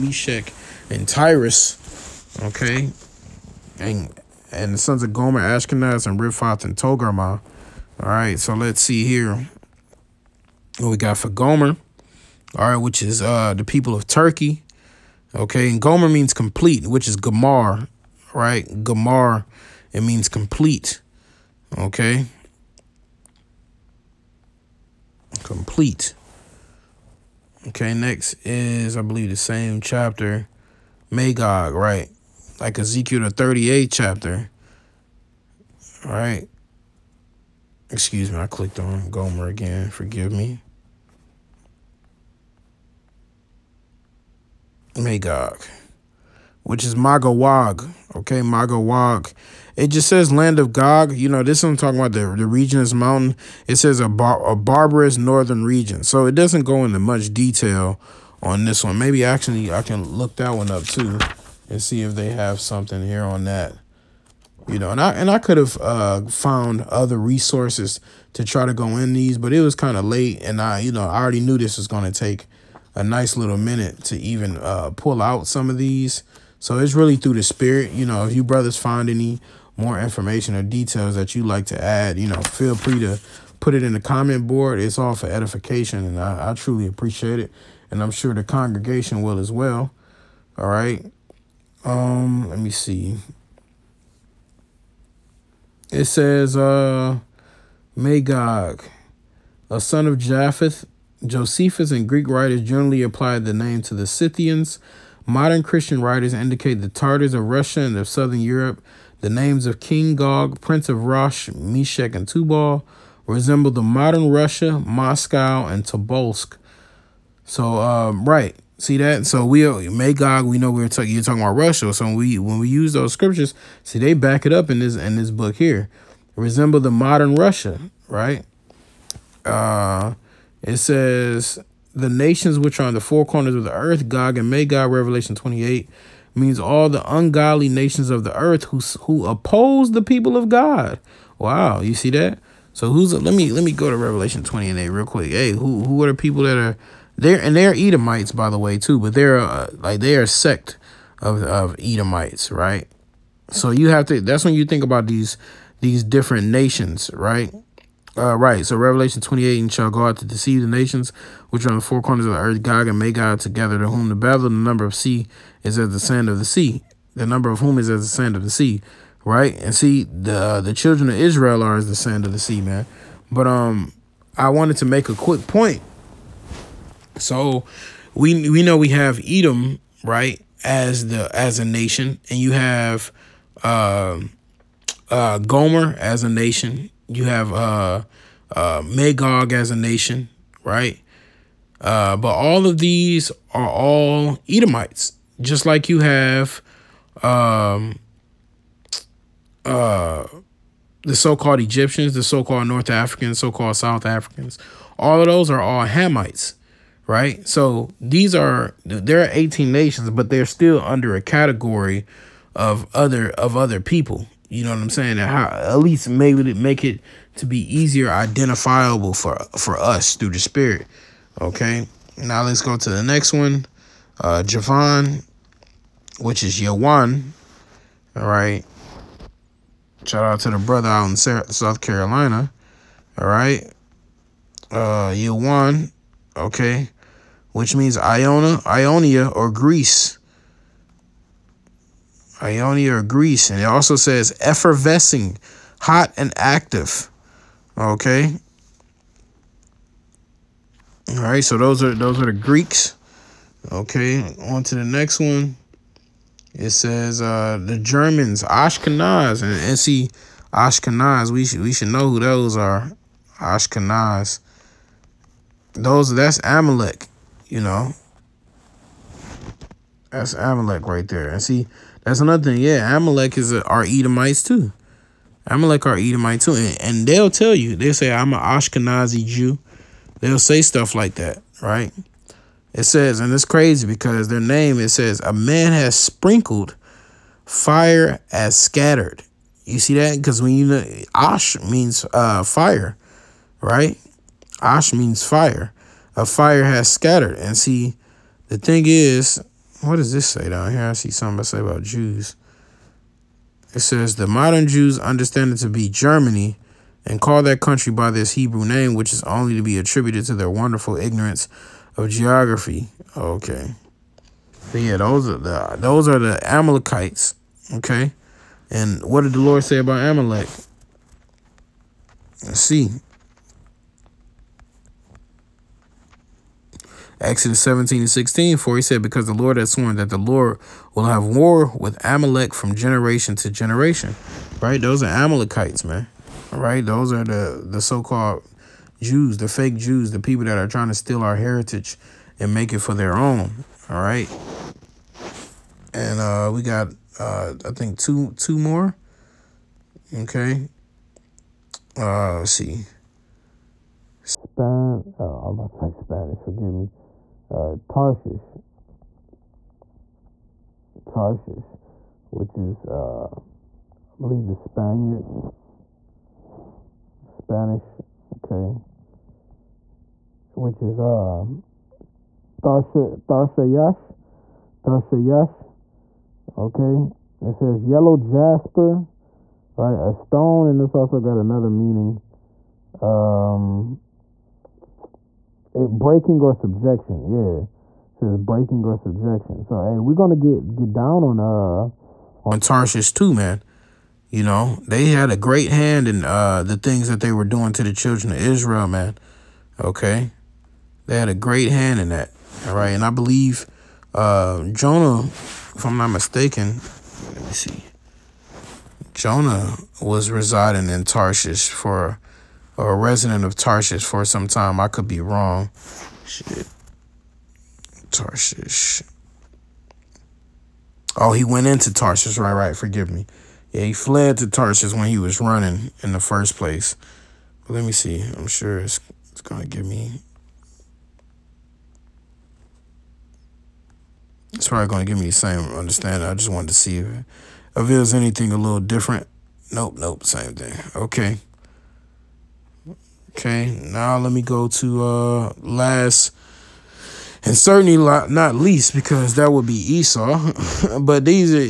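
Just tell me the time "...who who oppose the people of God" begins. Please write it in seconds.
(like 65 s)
138 s.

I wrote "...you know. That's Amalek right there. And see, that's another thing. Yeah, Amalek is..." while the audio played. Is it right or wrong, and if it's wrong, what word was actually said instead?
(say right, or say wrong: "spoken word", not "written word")
right.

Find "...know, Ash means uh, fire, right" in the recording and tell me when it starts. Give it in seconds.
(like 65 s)
290 s.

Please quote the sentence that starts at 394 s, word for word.
You know they had a great hand in uh the things that they were doing to the children of Israel, man.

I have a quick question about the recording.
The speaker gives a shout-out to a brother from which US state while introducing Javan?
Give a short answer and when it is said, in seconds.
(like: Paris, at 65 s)
South Carolina, at 231 s.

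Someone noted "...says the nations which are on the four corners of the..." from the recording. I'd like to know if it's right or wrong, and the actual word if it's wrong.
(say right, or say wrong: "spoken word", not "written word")
right.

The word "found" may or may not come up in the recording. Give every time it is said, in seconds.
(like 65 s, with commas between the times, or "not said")
66 s.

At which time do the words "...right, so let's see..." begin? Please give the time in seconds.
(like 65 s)
8 s.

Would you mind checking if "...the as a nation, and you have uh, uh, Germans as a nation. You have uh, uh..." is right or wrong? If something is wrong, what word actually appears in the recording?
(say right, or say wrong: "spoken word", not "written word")
wrong: "Gomer", not "Germans".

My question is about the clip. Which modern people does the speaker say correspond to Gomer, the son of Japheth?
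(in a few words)
The people of Turkey.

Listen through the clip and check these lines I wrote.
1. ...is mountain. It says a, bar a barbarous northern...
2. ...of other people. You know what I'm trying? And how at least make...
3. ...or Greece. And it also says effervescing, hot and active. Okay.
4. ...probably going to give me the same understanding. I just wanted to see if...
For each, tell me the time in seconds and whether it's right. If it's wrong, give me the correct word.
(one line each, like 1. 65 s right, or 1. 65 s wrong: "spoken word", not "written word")
1. 52 s right
2. 213 s wrong: "saying", not "trying"
3. 242 s right
4. 434 s right.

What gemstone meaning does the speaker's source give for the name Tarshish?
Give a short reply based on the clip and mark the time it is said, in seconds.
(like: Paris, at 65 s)
Yellow jasper, at 377 s.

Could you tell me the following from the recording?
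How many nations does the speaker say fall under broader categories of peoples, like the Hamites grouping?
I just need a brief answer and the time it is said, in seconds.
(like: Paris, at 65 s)
18, at 209 s.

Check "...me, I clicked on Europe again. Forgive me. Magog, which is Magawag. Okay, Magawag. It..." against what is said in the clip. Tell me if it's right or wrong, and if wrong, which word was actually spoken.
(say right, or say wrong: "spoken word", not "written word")
wrong: "Gomer", not "Europe".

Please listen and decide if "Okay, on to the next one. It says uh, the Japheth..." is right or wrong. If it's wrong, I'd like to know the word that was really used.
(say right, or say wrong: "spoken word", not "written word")
wrong: "Germans", not "Japheth".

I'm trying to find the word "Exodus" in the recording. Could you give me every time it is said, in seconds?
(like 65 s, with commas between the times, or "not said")
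327 s.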